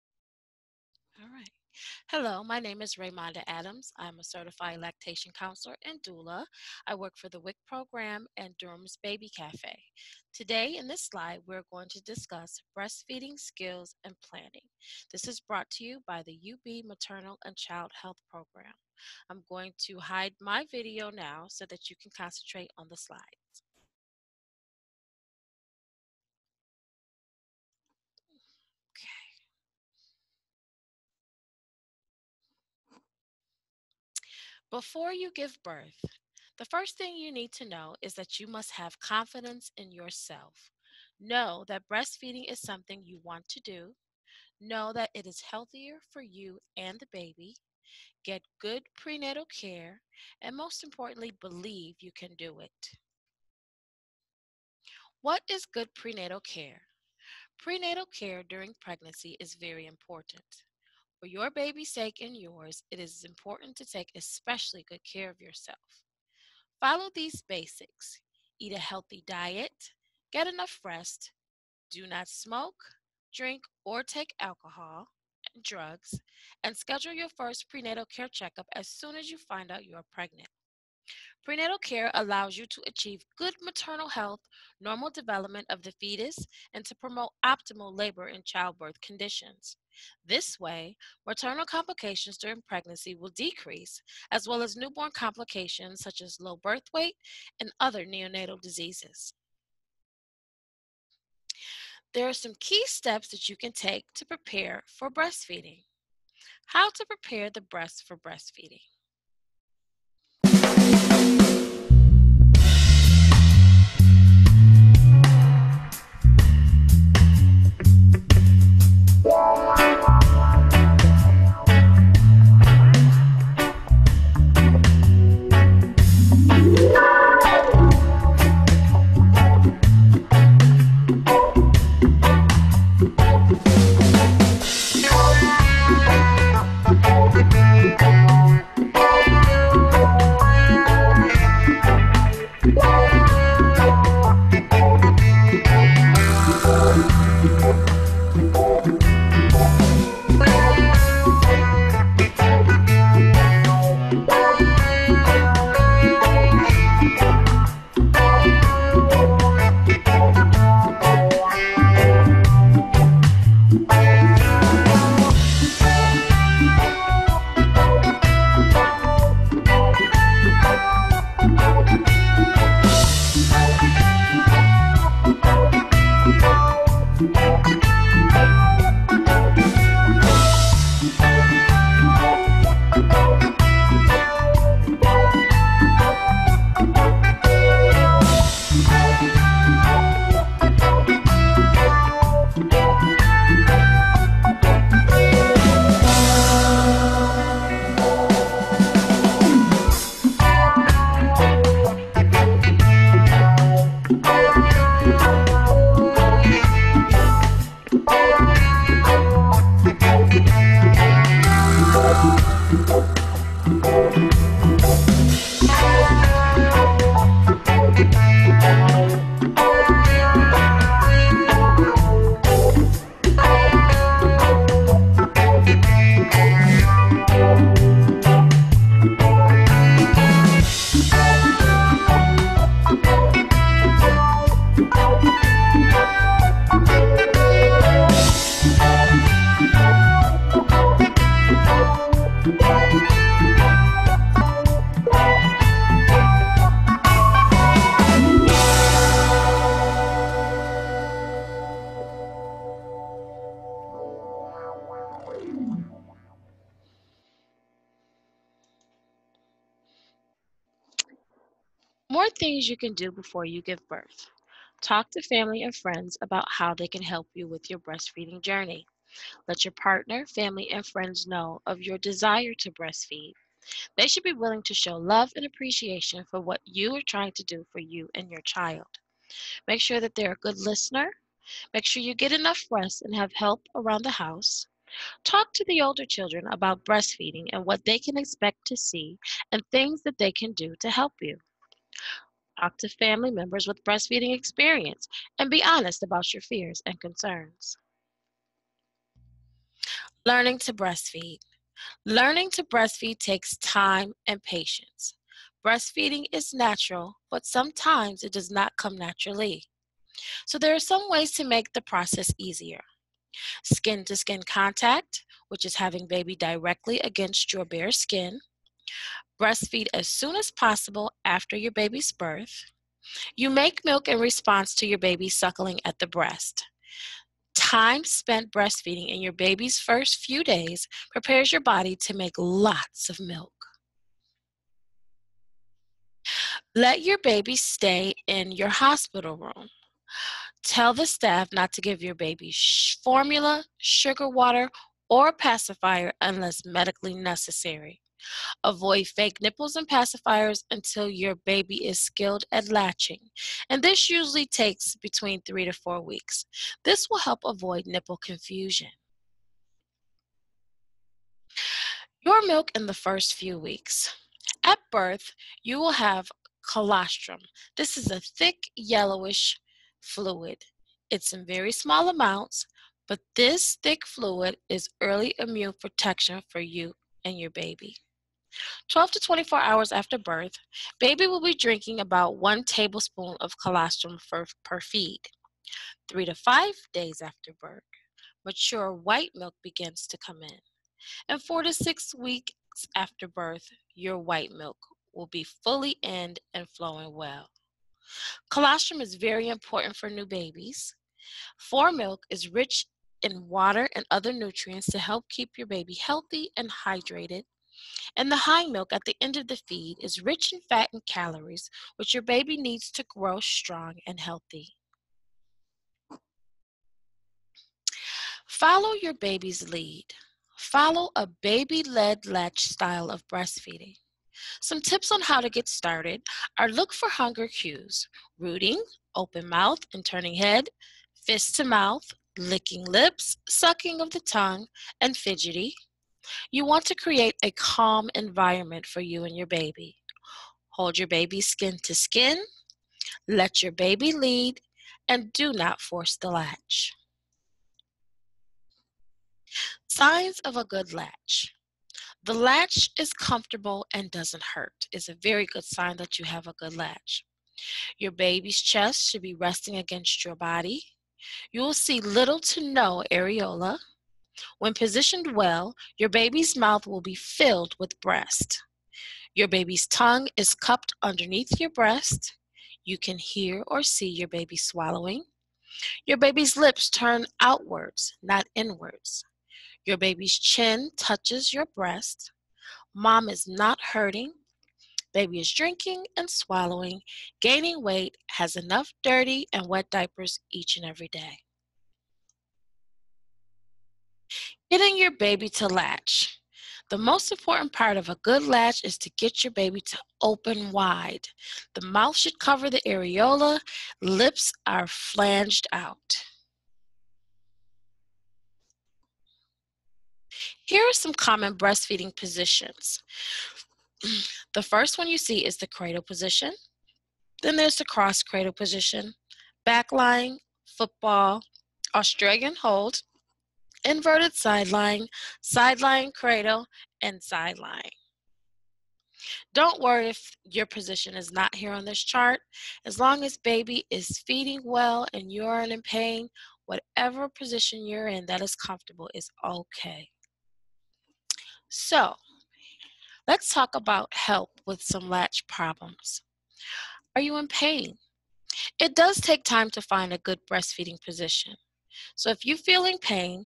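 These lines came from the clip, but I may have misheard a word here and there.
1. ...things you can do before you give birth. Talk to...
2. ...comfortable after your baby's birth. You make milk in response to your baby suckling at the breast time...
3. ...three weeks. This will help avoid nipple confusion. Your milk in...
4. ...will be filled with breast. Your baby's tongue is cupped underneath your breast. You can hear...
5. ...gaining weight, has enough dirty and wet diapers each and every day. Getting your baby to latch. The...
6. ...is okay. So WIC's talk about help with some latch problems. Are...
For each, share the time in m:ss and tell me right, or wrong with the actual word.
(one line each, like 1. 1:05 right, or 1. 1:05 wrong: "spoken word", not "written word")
1. 4:22 right
2. 5:20 wrong: "possible", not "comfortable"
3. 5:55 wrong: "four", not "three"
4. 7:46 right
5. 8:07 right
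6. 8:59 wrong: "Let", not "WIC".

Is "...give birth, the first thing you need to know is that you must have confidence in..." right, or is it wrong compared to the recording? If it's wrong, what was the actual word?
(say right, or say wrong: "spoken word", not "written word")
right.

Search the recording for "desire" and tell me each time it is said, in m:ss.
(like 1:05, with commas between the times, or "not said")
4:31.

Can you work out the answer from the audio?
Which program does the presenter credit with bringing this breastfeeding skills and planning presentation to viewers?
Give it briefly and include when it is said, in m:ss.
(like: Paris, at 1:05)
UB Maternal and Child Health Program, at 0:16.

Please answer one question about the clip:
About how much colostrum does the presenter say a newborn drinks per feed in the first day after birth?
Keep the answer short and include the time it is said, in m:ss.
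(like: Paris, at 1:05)
1 tablespoon, at 6:22.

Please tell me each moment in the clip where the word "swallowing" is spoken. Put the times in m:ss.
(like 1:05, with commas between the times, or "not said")
7:54, 8:06.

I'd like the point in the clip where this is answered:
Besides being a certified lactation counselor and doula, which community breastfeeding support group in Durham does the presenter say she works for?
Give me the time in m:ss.
0:09.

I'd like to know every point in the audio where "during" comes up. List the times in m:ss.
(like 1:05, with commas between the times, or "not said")
0:58, 1:32.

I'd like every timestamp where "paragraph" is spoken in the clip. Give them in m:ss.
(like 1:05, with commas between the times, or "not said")
not said.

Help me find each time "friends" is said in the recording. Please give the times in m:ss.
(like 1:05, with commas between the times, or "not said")
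4:25, 4:30.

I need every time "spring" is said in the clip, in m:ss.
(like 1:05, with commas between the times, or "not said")
not said.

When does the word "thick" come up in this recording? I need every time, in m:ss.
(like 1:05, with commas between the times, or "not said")
6:08, 6:13.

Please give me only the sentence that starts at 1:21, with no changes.
Prenatal care allows you to achieve good maternal health, normal development of the fetus, and to promote optimal labor and childbirth conditions.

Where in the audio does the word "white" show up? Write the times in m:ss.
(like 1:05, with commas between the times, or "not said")
6:28, 6:34.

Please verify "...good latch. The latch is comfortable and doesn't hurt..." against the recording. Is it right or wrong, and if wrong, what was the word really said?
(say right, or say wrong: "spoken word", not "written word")
right.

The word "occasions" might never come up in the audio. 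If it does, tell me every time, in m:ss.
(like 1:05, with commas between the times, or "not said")
not said.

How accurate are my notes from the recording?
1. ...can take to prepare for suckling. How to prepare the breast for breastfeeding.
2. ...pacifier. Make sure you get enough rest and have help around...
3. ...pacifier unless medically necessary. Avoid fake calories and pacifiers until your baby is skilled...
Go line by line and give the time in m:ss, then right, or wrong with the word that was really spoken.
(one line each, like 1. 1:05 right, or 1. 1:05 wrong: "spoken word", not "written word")
1. 1:43 wrong: "breastfeeding", not "suckling"
2. 4:40 wrong: "listener", not "pacifier"
3. 5:45 wrong: "nipples", not "calories".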